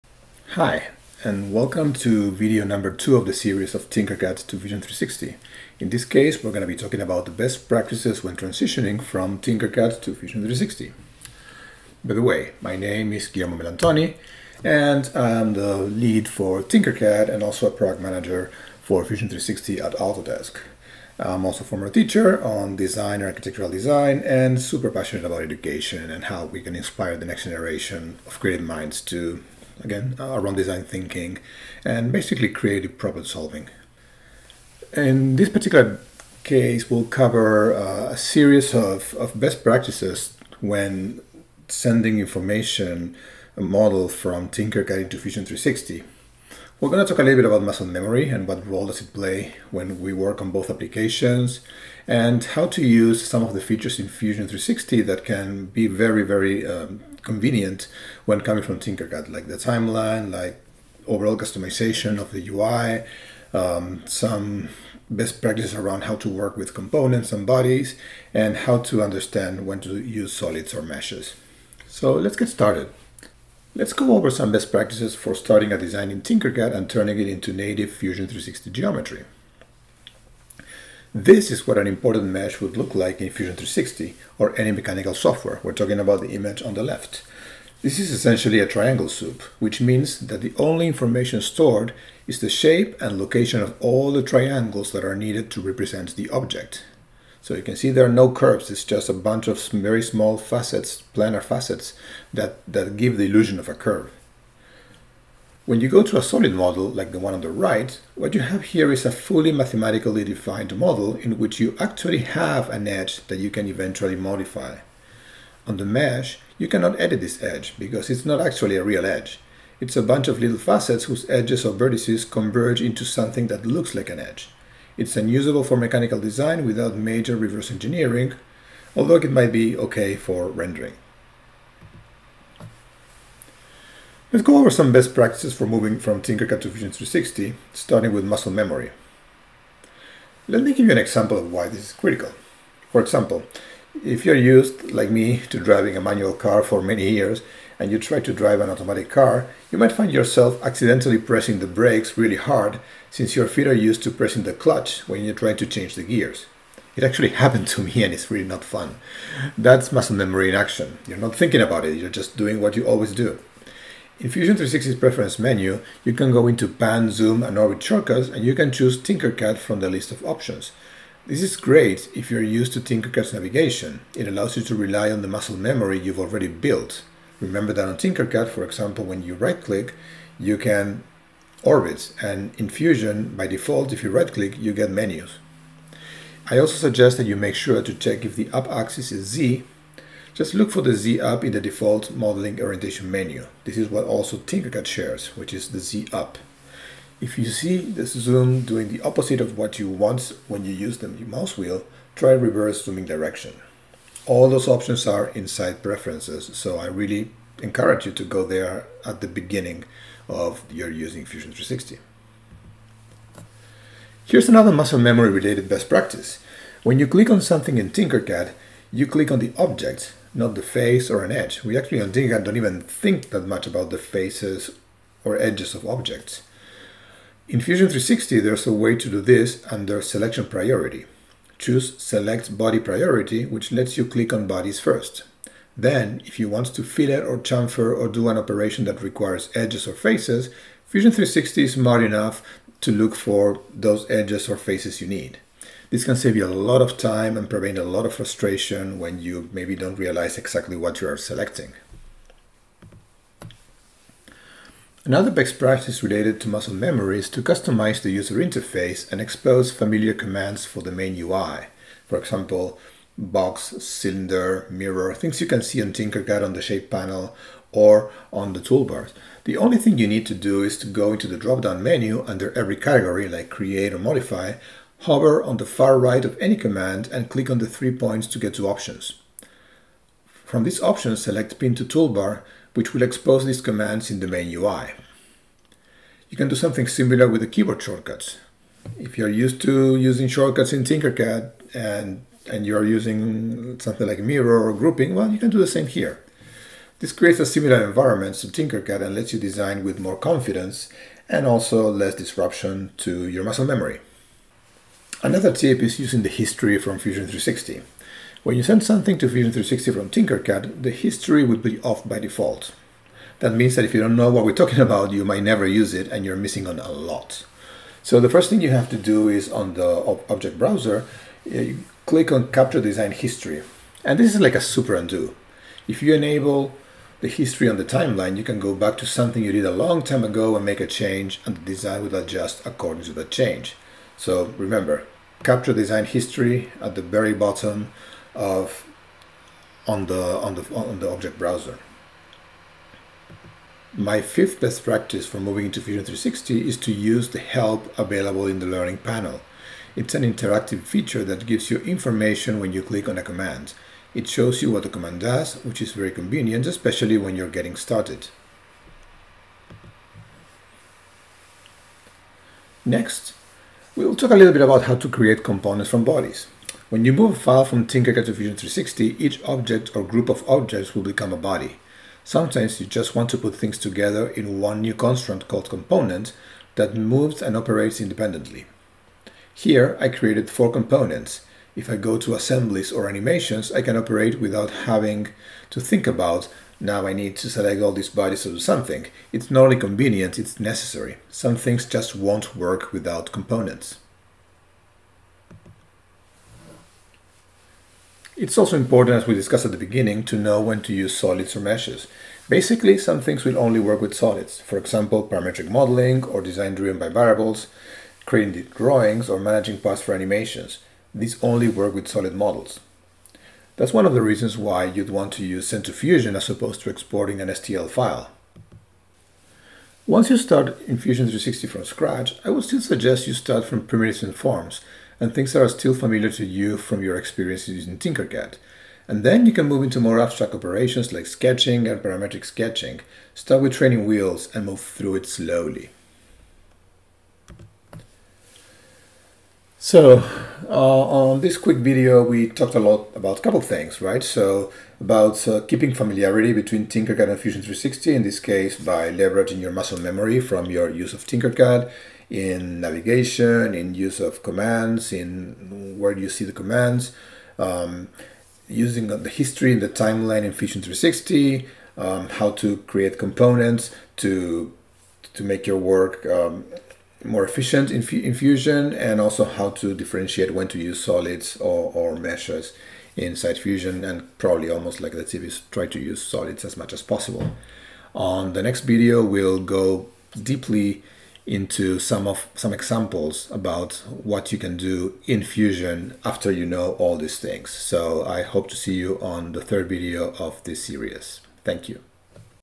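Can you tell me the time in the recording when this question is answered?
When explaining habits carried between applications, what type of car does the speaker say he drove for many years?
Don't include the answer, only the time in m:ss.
2:26.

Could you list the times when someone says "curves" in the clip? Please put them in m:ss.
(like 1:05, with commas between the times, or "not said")
1:38, 1:43.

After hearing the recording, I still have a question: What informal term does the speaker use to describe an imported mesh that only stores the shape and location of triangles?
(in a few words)
triangle soup.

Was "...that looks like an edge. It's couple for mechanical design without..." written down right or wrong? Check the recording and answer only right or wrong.
wrong.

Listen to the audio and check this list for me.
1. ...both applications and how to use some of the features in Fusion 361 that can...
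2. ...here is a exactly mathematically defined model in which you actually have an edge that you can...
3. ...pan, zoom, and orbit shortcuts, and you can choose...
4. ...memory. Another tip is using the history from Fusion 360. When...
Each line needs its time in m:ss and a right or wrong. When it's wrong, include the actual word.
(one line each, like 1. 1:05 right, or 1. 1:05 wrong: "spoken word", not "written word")
1. 0:50 wrong: "360", not "361"
2. 1:48 wrong: "fully", not "exactly"
3. 2:46 right
4. 5:03 right.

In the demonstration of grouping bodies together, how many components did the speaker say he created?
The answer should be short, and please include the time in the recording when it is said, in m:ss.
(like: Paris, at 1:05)
4, at 6:20.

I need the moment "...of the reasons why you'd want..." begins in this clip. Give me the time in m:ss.
6:54.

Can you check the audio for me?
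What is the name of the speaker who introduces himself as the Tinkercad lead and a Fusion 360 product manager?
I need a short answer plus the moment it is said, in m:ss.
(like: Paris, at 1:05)
Guillermo Melantoni, at 0:13.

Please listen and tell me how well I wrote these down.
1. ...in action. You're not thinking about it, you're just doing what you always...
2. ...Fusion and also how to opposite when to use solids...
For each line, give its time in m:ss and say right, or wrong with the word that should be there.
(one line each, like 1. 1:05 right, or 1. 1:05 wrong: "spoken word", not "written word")
1. 2:40 right
2. 7:48 wrong: "differentiate", not "opposite".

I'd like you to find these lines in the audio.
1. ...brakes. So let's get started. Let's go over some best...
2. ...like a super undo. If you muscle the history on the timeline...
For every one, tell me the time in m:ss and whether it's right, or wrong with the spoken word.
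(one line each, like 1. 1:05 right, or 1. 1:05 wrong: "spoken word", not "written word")
1. 1:10 wrong: "meshes", not "brakes"
2. 5:24 wrong: "enable", not "muscle".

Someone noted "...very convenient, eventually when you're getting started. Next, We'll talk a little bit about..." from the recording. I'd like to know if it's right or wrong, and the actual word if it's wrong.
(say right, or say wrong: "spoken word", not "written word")
wrong: "especially", not "eventually".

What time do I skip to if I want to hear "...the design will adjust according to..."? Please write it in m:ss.
5:31.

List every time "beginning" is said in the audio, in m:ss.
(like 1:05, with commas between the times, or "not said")
3:29, 6:39.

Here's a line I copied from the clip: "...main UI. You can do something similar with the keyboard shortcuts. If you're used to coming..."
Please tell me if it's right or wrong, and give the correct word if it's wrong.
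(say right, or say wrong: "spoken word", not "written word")
wrong: "using", not "coming".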